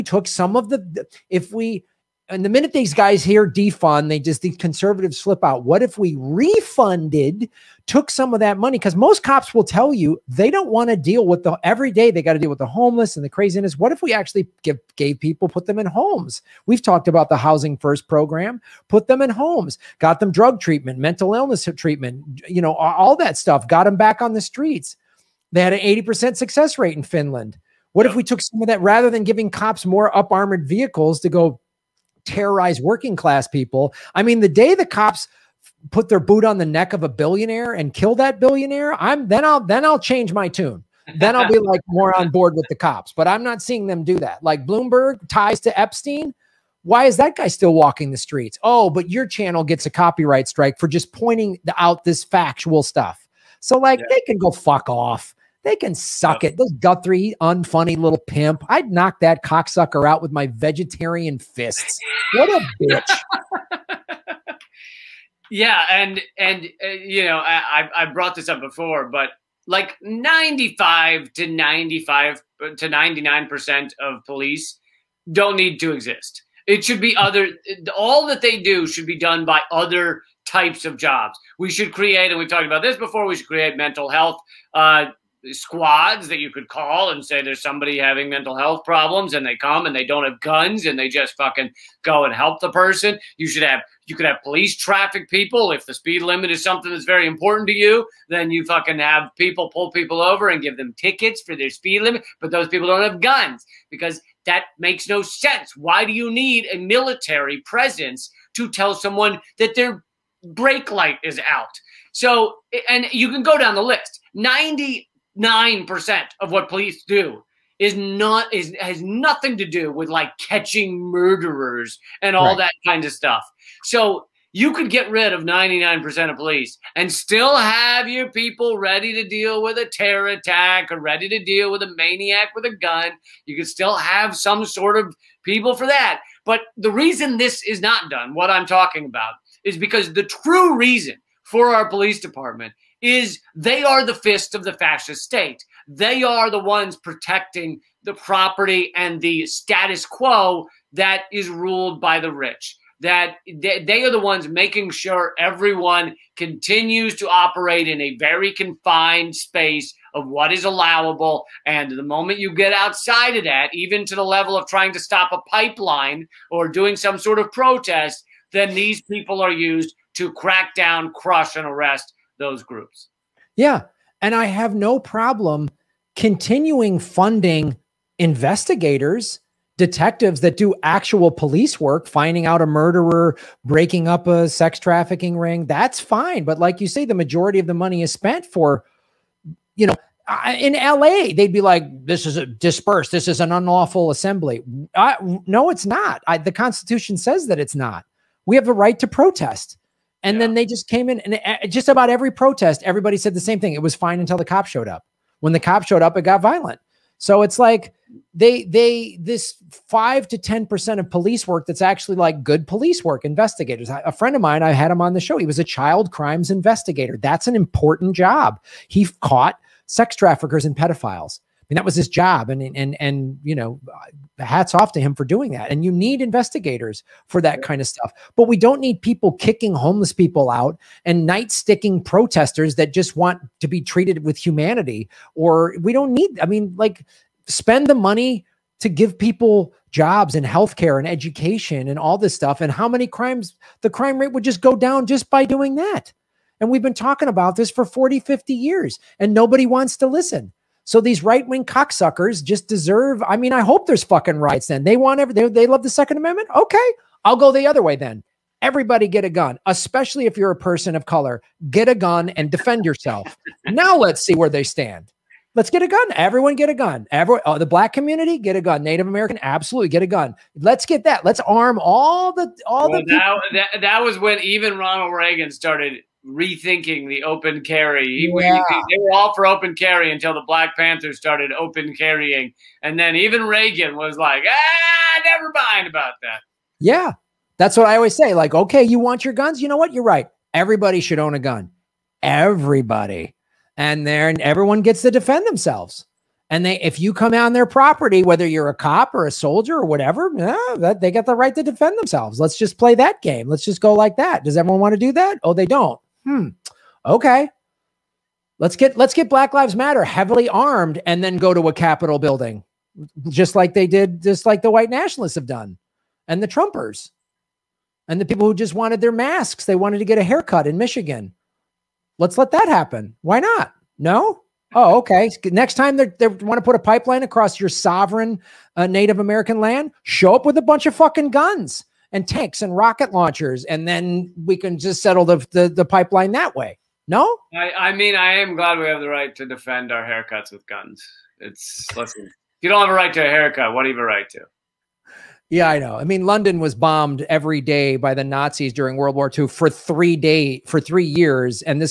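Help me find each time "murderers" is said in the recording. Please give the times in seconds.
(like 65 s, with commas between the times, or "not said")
121 s, 182 s.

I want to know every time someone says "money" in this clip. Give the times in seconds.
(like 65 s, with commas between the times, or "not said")
8 s, 187 s, 237 s.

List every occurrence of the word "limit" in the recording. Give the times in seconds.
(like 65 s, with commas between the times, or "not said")
96 s, 102 s.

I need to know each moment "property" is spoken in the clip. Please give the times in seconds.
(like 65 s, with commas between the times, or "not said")
148 s, 297 s.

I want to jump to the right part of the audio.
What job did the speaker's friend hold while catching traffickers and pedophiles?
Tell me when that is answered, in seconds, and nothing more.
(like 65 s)
215 s.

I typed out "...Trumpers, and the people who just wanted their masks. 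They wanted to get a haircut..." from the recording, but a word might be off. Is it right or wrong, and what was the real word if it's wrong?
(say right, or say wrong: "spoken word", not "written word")
right.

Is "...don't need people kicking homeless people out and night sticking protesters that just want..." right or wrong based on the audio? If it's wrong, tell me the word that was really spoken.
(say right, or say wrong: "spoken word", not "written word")
right.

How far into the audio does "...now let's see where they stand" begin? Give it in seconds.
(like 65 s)
263 s.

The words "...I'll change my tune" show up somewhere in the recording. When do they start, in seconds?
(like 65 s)
39 s.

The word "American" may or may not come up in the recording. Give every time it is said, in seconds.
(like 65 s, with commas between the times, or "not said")
269 s, 329 s.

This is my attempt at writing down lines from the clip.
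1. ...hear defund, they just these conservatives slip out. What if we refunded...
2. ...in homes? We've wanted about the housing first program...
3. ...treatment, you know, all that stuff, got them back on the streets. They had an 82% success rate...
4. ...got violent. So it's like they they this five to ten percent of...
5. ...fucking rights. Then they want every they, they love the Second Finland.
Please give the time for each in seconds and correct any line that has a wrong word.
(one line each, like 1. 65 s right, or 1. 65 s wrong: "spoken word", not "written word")
1. 3 s right
2. 15 s wrong: "talked", not "wanted"
3. 21 s wrong: "80", not "82"
4. 206 s right
5. 254 s wrong: "Amendment", not "Finland".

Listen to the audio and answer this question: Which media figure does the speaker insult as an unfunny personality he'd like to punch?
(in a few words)
Gutfeld.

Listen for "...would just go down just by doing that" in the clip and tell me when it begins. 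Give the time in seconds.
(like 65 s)
244 s.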